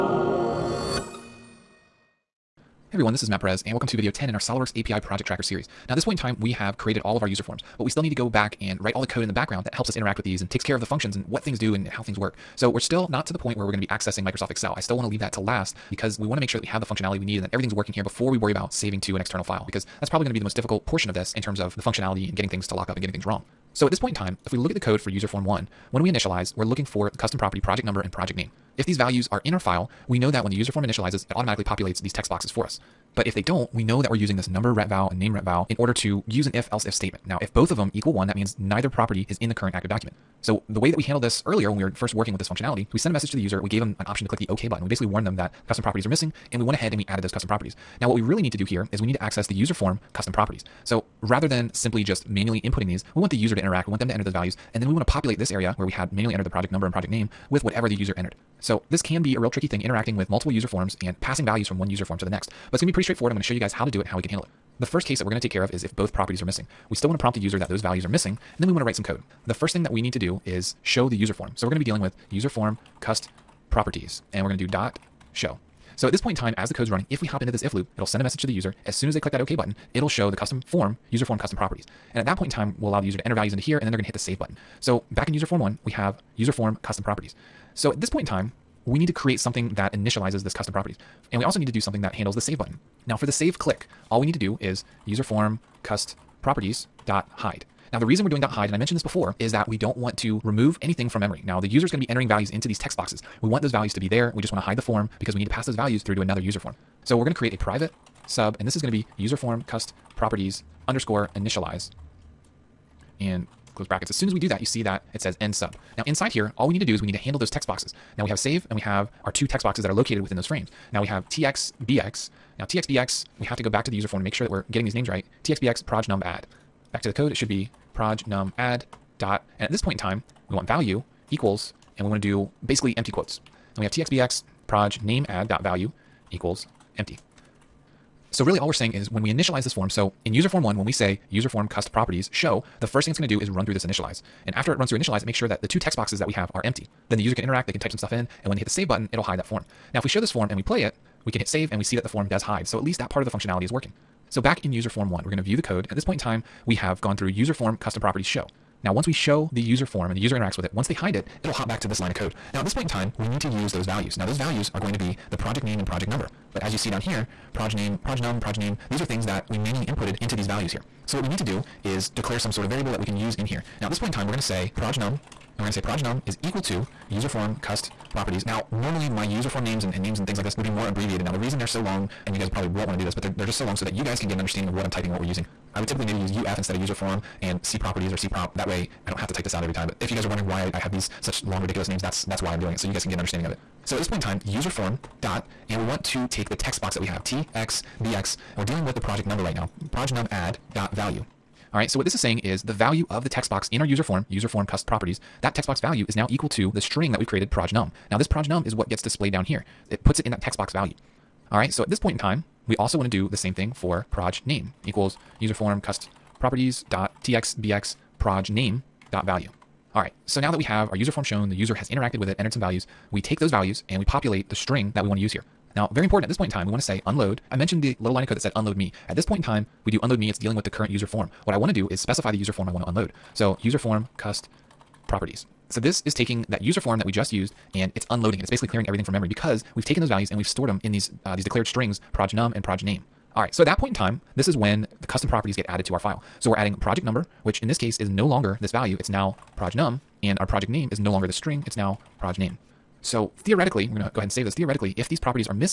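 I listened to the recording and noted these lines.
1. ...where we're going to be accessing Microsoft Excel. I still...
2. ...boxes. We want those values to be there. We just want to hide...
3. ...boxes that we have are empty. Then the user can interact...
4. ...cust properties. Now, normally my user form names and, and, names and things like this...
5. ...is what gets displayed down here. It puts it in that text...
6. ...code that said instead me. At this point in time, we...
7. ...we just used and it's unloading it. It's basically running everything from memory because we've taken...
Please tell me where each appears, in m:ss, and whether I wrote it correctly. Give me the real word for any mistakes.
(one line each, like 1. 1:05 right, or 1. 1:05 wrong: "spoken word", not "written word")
1. 0:13 right
2. 1:42 right
3. 2:25 right
4. 2:57 right
5. 3:28 right
6. 3:48 wrong: "unload", not "instead"
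7. 3:57 wrong: "clearing", not "running".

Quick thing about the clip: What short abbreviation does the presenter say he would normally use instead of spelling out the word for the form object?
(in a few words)
UF.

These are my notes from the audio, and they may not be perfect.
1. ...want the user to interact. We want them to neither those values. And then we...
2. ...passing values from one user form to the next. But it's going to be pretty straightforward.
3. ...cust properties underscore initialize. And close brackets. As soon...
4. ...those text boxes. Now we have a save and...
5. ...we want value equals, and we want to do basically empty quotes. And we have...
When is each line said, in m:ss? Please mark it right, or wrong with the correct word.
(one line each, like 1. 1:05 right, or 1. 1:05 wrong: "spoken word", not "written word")
1. 0:53 wrong: "enter", not "neither"
2. 1:01 right
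3. 1:49 right
4. 1:57 right
5. 2:10 right.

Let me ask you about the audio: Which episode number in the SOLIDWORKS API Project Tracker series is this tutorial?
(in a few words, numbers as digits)
10.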